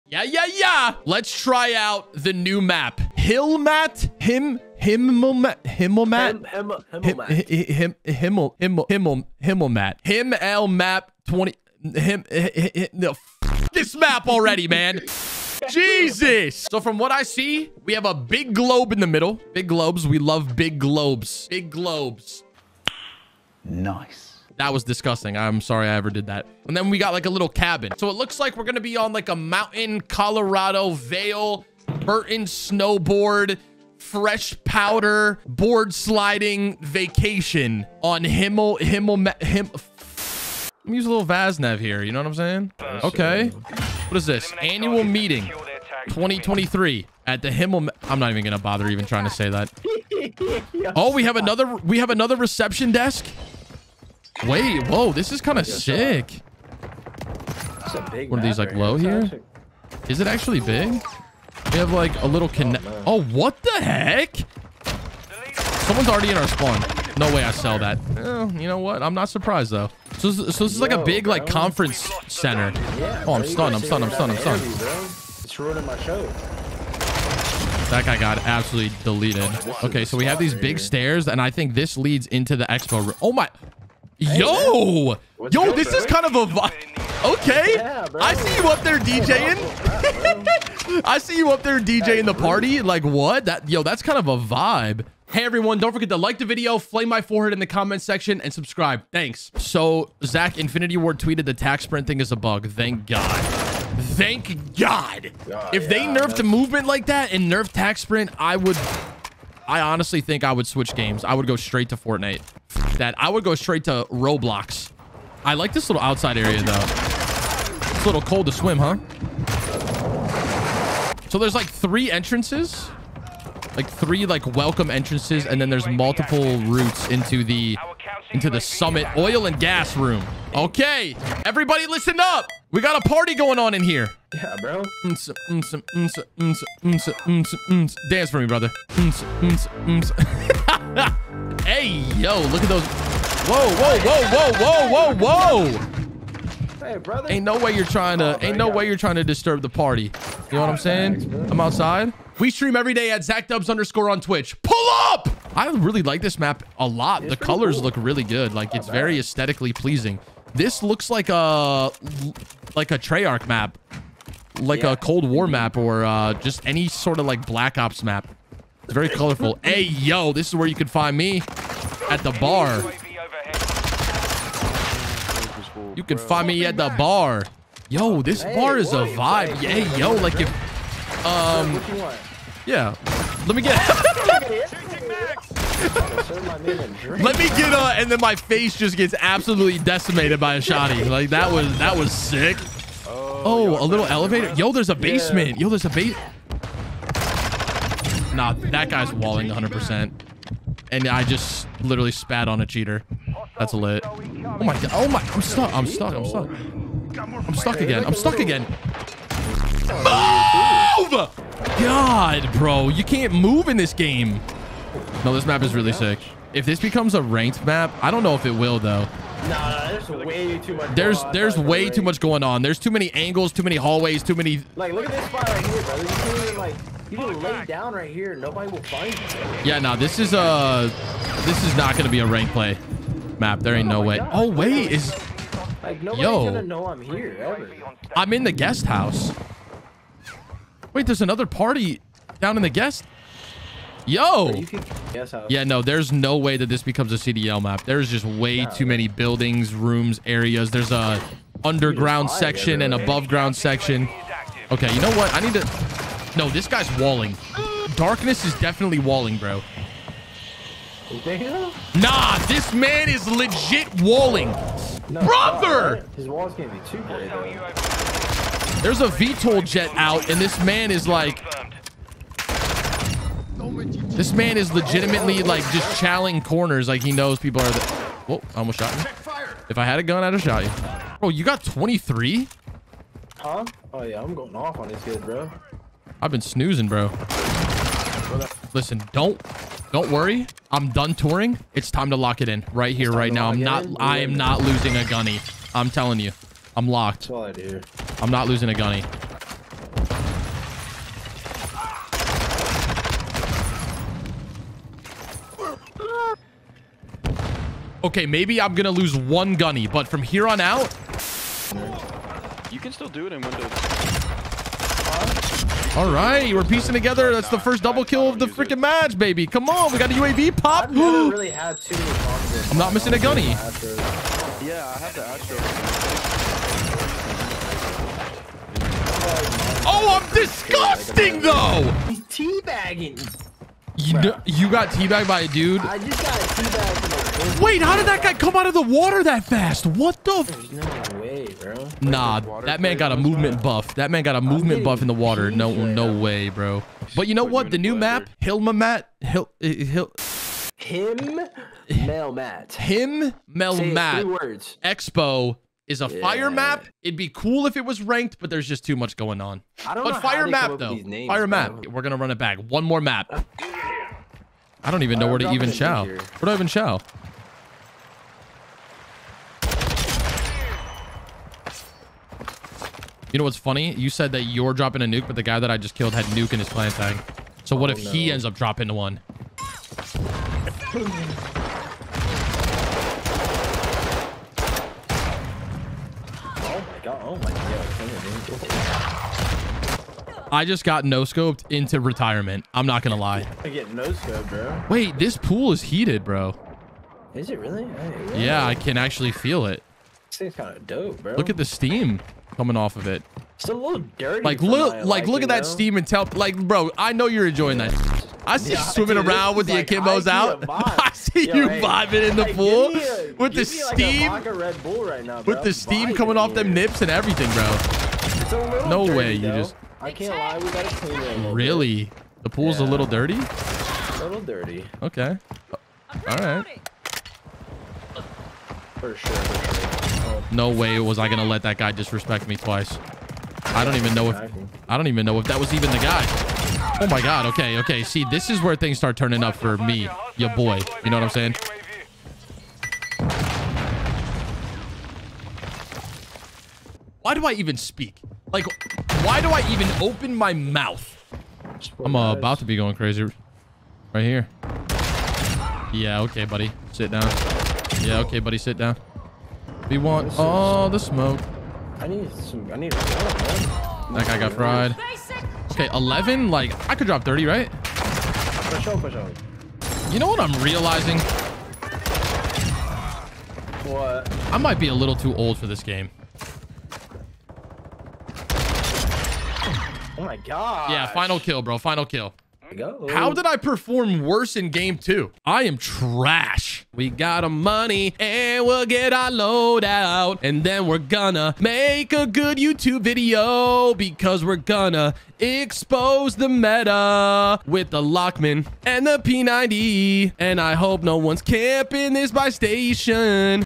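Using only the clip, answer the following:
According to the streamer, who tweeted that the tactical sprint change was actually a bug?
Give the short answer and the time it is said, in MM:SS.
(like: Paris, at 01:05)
Zach Infinity Ward, at 01:40.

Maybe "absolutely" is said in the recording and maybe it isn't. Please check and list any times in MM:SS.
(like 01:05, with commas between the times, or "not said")
01:18, 03:09.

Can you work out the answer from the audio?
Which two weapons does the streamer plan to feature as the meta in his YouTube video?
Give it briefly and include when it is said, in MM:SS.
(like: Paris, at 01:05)
Lachmann and P90, at 08:18.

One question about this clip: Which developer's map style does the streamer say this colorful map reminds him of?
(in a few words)
Treyarch.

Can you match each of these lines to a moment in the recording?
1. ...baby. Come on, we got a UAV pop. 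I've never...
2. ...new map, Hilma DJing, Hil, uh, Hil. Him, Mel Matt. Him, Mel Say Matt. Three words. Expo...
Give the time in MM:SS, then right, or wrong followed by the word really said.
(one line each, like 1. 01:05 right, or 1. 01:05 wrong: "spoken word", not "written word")
1. 05:19 right
2. 05:47 wrong: "Matt", not "DJing".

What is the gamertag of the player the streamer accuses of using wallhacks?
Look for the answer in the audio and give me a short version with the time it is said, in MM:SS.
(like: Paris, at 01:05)
Darkness, at 04:17.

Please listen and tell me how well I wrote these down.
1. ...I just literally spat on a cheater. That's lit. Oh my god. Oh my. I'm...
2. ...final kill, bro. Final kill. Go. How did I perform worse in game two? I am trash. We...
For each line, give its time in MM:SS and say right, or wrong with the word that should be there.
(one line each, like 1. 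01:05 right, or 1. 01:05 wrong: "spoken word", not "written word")
1. 03:21 right
2. 08:01 right.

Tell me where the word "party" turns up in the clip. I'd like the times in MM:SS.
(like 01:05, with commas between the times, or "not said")
01:32, 02:13, 02:29, 04:01.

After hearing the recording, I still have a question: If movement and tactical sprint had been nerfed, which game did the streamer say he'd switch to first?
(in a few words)
Fortnite.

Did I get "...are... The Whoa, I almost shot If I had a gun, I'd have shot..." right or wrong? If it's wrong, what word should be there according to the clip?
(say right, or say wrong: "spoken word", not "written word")
right.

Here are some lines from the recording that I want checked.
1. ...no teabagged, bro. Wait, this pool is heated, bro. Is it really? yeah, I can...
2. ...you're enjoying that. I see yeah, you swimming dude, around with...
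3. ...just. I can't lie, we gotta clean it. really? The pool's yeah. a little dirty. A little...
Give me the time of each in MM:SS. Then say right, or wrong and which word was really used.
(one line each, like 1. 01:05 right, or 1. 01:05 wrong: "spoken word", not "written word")
1. 06:33 wrong: "scoped", not "teabagged"
2. 06:47 right
3. 06:59 right.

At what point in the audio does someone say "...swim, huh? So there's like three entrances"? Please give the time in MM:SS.
01:58.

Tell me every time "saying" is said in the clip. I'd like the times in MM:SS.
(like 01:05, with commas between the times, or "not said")
00:42, 02:30, 07:21.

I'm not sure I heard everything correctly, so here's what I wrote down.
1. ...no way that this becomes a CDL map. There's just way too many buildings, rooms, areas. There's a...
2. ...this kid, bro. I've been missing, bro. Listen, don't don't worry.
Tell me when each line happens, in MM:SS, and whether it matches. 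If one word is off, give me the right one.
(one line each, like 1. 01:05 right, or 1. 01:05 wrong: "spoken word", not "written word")
1. 04:06 right
2. 04:44 wrong: "snoozing", not "missing".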